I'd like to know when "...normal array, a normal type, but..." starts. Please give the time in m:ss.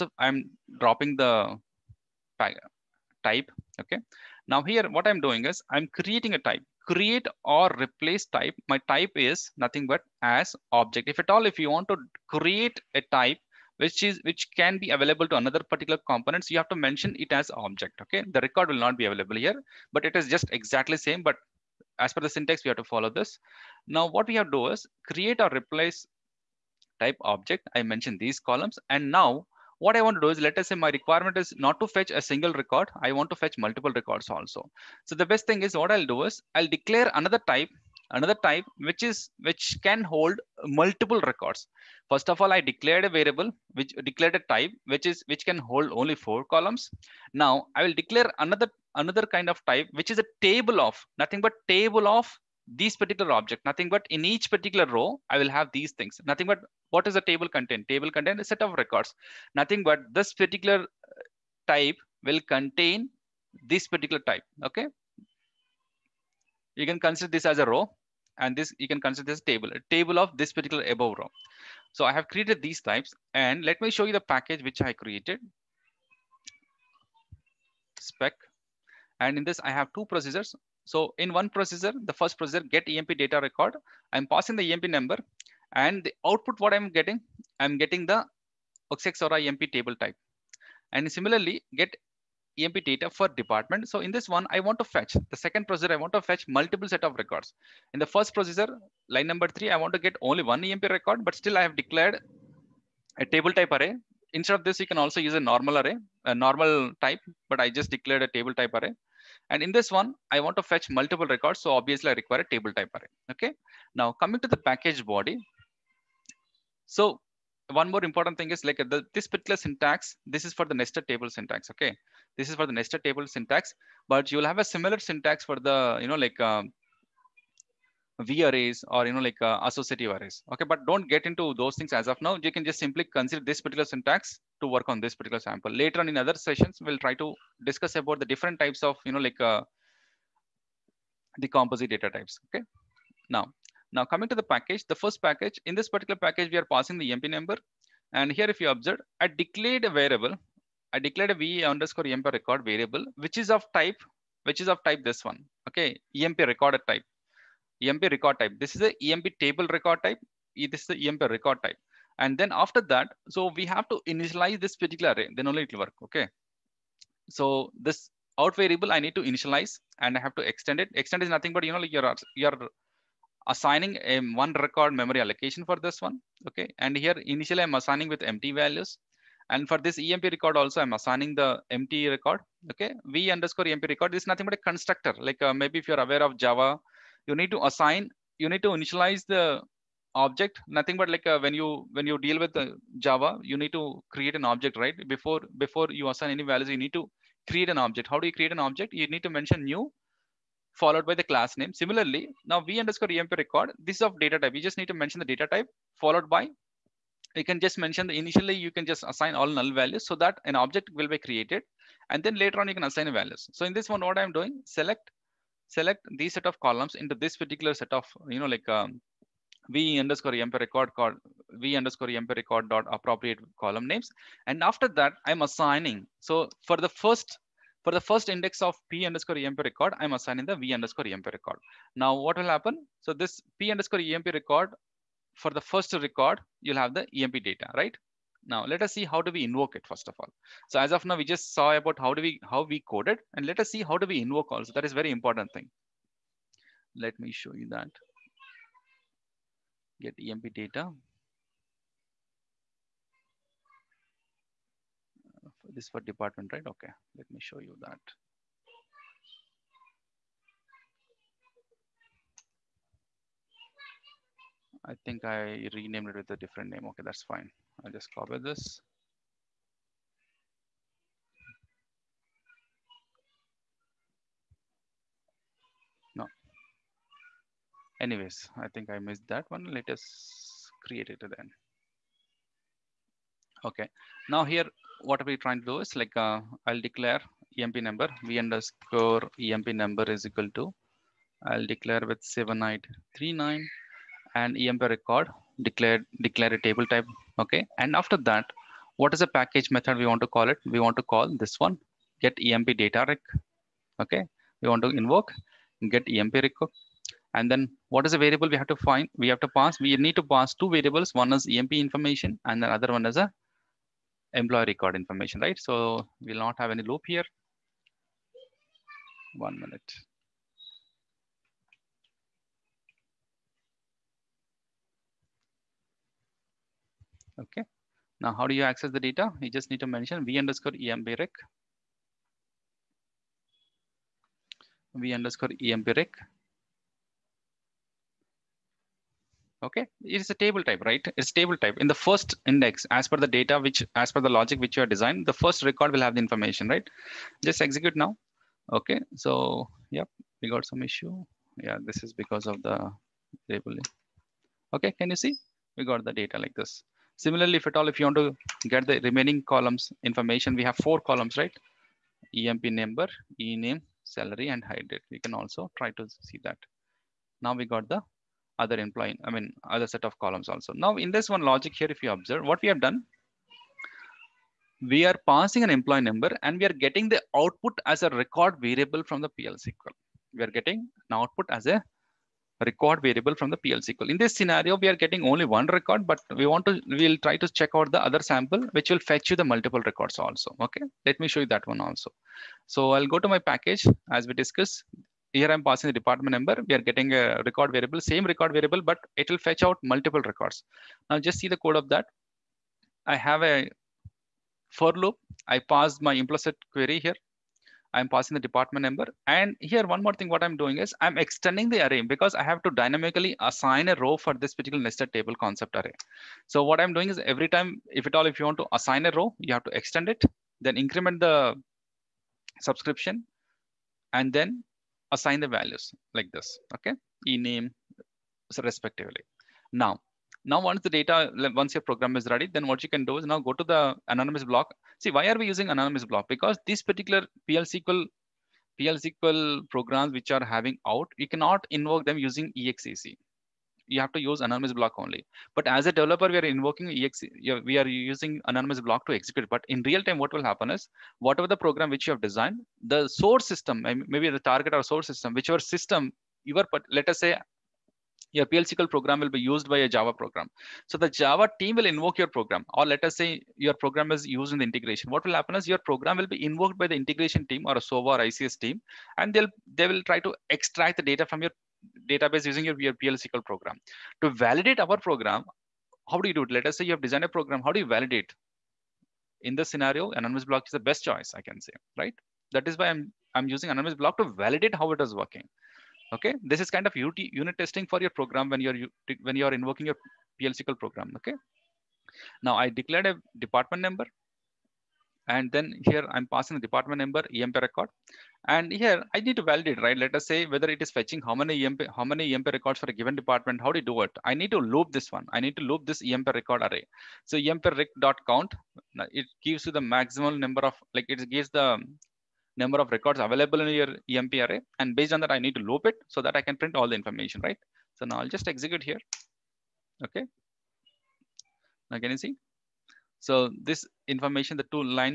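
1:45.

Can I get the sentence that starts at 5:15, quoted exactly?
So we'll not have any loop here.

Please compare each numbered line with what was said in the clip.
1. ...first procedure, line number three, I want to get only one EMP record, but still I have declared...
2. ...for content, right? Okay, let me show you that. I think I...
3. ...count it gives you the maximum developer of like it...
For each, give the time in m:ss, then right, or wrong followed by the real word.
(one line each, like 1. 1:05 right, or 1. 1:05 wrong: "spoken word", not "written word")
1. 1:38 right
2. 4:15 wrong: "department", not "content"
3. 8:28 wrong: "number", not "developer".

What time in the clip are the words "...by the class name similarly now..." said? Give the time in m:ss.
3:21.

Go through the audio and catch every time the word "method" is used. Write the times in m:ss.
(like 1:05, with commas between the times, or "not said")
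4:59.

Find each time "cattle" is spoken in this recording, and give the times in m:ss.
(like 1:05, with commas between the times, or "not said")
not said.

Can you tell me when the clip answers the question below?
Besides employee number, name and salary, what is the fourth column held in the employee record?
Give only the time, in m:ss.
6:04.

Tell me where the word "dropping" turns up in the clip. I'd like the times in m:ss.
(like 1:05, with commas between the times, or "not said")
0:00.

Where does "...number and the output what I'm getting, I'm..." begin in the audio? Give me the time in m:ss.
1:24.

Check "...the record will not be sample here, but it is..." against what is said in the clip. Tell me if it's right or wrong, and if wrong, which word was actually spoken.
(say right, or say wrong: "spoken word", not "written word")
wrong: "available", not "sample".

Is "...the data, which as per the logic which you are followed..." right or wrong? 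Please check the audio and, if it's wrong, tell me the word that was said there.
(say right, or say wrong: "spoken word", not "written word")
wrong: "designed", not "followed".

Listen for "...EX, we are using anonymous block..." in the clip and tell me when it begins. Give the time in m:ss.
7:26.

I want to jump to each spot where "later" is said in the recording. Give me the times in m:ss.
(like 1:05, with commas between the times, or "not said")
2:15, 3:32.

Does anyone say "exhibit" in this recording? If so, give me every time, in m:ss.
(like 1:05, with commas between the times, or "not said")
not said.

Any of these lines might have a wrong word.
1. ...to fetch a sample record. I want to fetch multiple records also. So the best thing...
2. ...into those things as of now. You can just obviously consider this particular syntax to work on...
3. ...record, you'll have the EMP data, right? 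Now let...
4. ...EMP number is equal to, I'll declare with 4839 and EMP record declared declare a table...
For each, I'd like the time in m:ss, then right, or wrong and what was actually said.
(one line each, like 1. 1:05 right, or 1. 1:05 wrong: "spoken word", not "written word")
1. 0:31 wrong: "single", not "sample"
2. 2:11 wrong: "simply", not "obviously"
3. 3:55 right
4. 4:49 wrong: "7839", not "4839".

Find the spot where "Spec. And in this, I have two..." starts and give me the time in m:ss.
1:17.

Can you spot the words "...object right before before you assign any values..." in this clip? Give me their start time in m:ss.
3:14.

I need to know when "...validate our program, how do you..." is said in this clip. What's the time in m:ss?
7:54.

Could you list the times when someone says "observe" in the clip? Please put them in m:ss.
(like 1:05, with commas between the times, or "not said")
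2:28, 6:12.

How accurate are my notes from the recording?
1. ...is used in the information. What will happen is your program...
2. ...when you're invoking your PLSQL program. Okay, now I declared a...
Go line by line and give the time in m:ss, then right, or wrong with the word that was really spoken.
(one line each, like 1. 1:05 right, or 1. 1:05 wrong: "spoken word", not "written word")
1. 7:44 wrong: "integration", not "information"
2. 8:09 right.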